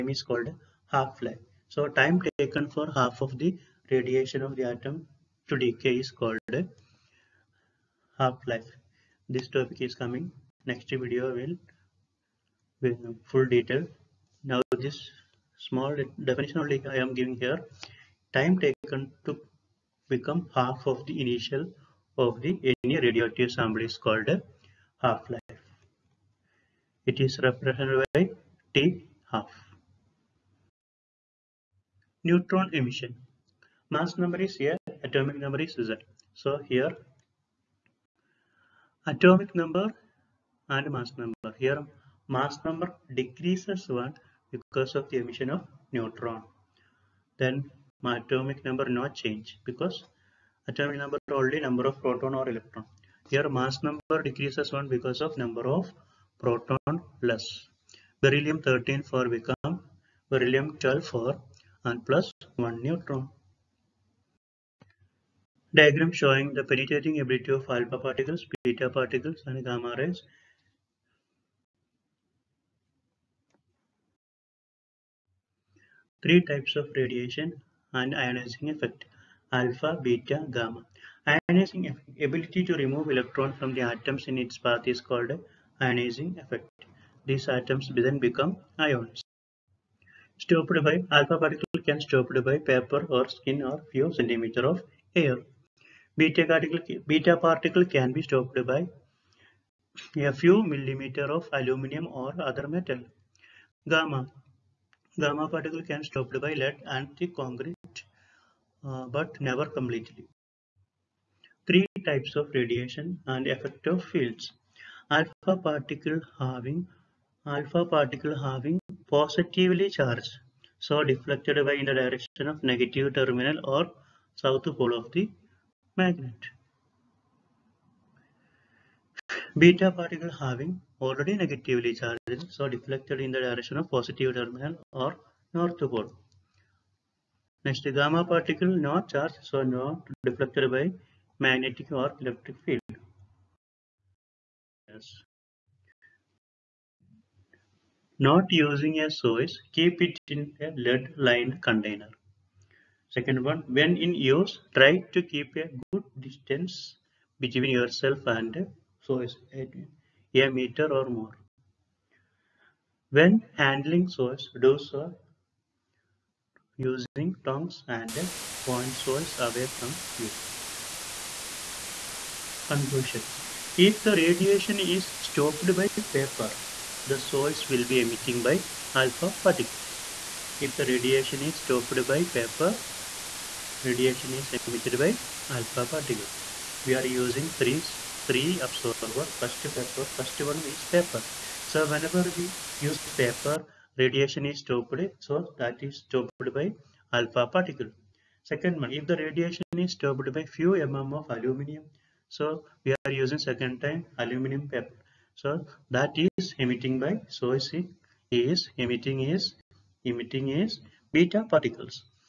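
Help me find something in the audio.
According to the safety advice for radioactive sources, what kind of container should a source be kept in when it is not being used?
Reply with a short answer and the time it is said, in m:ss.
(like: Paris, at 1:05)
Lead-lined container, at 2:30.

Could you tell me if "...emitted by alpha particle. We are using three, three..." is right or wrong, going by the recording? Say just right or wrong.
right.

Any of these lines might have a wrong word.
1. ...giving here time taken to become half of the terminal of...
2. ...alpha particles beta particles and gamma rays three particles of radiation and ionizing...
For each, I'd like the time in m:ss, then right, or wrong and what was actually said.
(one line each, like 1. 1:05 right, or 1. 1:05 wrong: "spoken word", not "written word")
1. 0:17 wrong: "initial", not "terminal"
2. 1:07 wrong: "types", not "particles".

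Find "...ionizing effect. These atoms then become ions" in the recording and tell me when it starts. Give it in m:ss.
1:25.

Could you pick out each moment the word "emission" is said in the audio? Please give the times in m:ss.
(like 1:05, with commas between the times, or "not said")
0:32, 0:45.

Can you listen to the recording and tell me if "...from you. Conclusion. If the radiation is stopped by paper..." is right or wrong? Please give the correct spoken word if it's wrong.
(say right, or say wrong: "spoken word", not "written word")
right.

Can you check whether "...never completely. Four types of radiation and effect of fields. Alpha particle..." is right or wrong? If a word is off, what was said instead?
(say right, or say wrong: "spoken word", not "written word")
wrong: "Three", not "Four".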